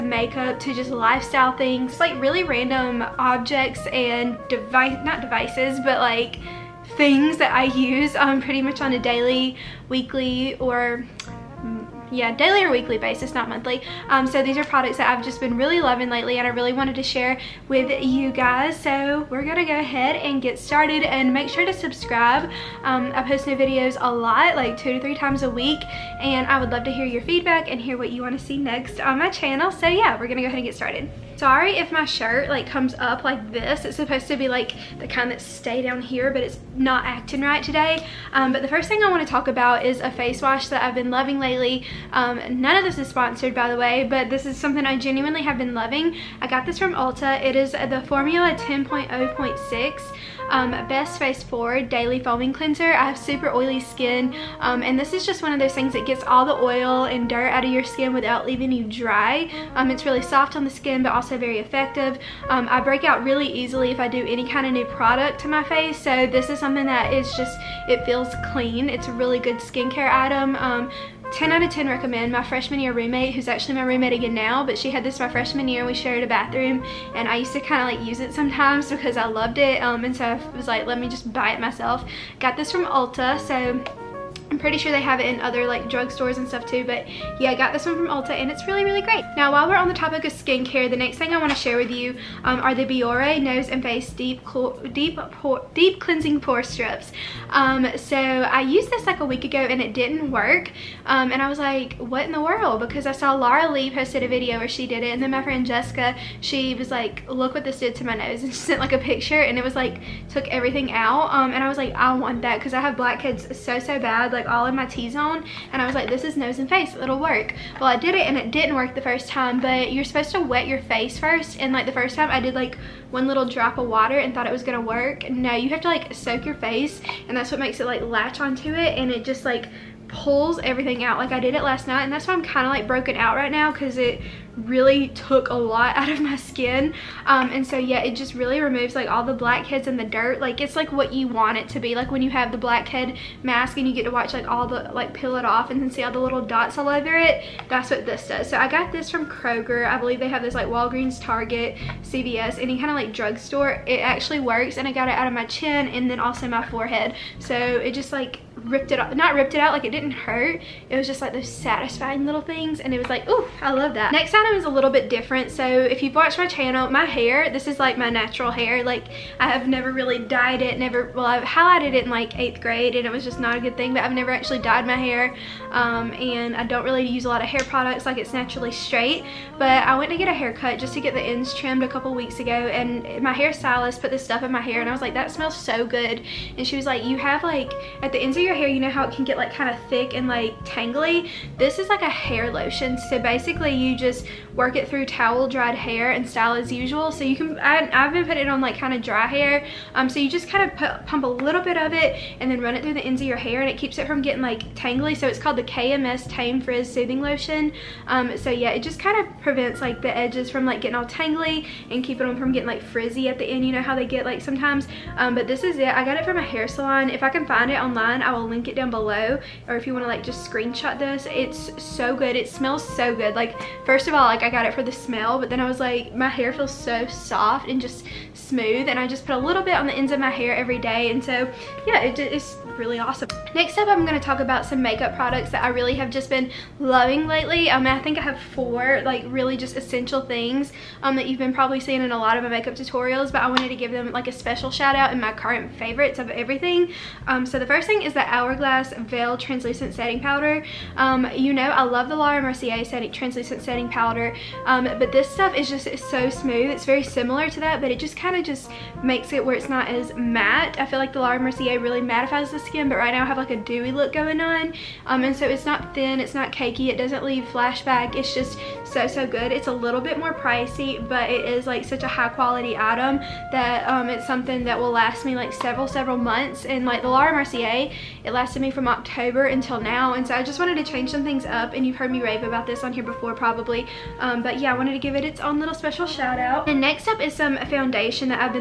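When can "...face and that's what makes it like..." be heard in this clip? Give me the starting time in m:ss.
2:06.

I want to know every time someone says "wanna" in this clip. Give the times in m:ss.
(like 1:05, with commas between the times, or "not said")
0:28, 1:31.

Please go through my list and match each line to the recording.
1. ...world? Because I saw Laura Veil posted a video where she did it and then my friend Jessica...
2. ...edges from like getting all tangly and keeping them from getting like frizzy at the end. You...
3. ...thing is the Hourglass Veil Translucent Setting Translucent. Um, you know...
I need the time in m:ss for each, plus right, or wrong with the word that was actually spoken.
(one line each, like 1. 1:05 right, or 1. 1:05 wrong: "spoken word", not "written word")
1. 1:42 wrong: "Lee", not "Veil"
2. 3:30 right
3. 4:07 wrong: "Powder", not "Translucent".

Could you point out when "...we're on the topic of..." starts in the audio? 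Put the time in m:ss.
1:29.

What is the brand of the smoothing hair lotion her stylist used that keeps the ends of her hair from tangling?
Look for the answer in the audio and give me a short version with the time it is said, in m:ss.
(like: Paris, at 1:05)
KMS, at 3:25.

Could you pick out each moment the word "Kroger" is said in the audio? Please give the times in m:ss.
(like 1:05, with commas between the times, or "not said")
2:29.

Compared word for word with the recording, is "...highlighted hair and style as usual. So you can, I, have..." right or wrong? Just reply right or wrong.
wrong.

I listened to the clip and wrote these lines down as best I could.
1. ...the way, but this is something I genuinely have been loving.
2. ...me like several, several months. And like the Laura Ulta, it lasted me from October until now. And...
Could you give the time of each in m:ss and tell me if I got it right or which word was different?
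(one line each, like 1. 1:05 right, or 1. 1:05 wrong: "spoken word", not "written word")
1. 0:43 right
2. 4:35 wrong: "Mercier", not "Ulta".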